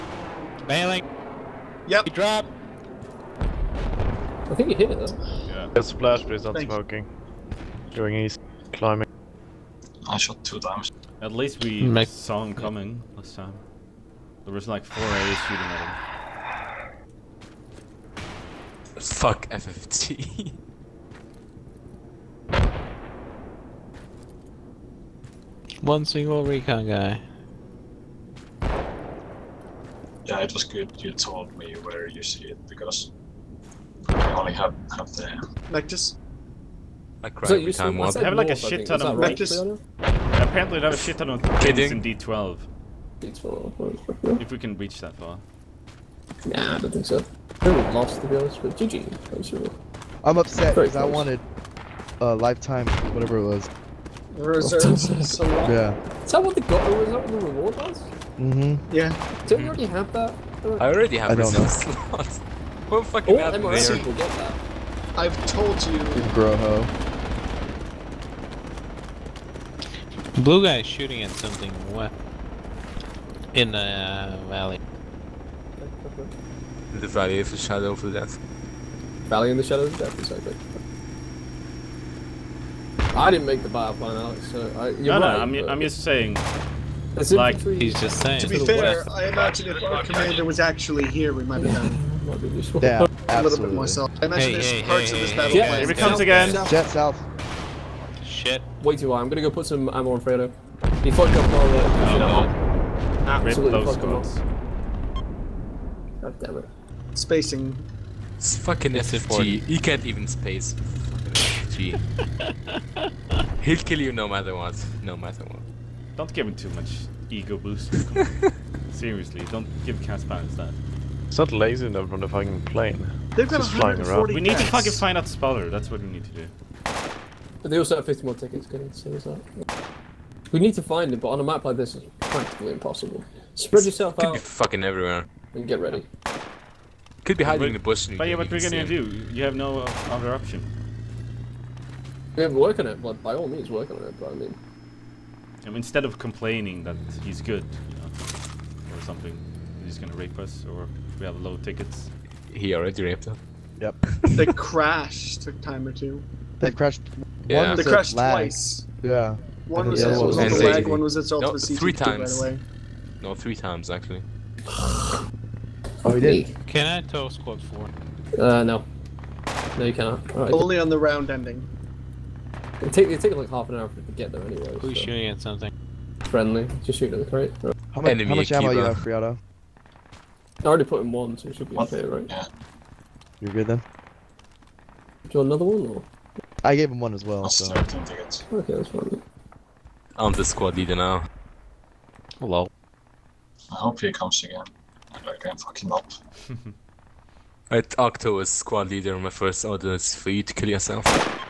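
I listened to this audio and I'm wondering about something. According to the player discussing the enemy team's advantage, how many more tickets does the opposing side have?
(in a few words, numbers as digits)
50.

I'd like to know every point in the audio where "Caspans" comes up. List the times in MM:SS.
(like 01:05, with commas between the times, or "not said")
02:00.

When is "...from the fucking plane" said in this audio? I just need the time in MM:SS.
02:02.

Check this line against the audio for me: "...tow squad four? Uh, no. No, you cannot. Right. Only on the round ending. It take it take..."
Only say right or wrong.
right.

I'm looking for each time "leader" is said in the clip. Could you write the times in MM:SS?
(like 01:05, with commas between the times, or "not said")
03:10, 03:18.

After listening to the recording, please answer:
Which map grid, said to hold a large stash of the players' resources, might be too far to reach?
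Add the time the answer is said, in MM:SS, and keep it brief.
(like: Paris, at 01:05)
D12, at 00:42.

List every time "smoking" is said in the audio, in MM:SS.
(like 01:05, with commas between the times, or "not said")
00:06.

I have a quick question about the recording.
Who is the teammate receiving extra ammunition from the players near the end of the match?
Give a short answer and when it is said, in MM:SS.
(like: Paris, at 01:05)
Friado, at 02:58.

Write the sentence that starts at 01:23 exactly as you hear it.
I didn't make the bio plan, Alex, so I, you're no, right, no, I'm, but...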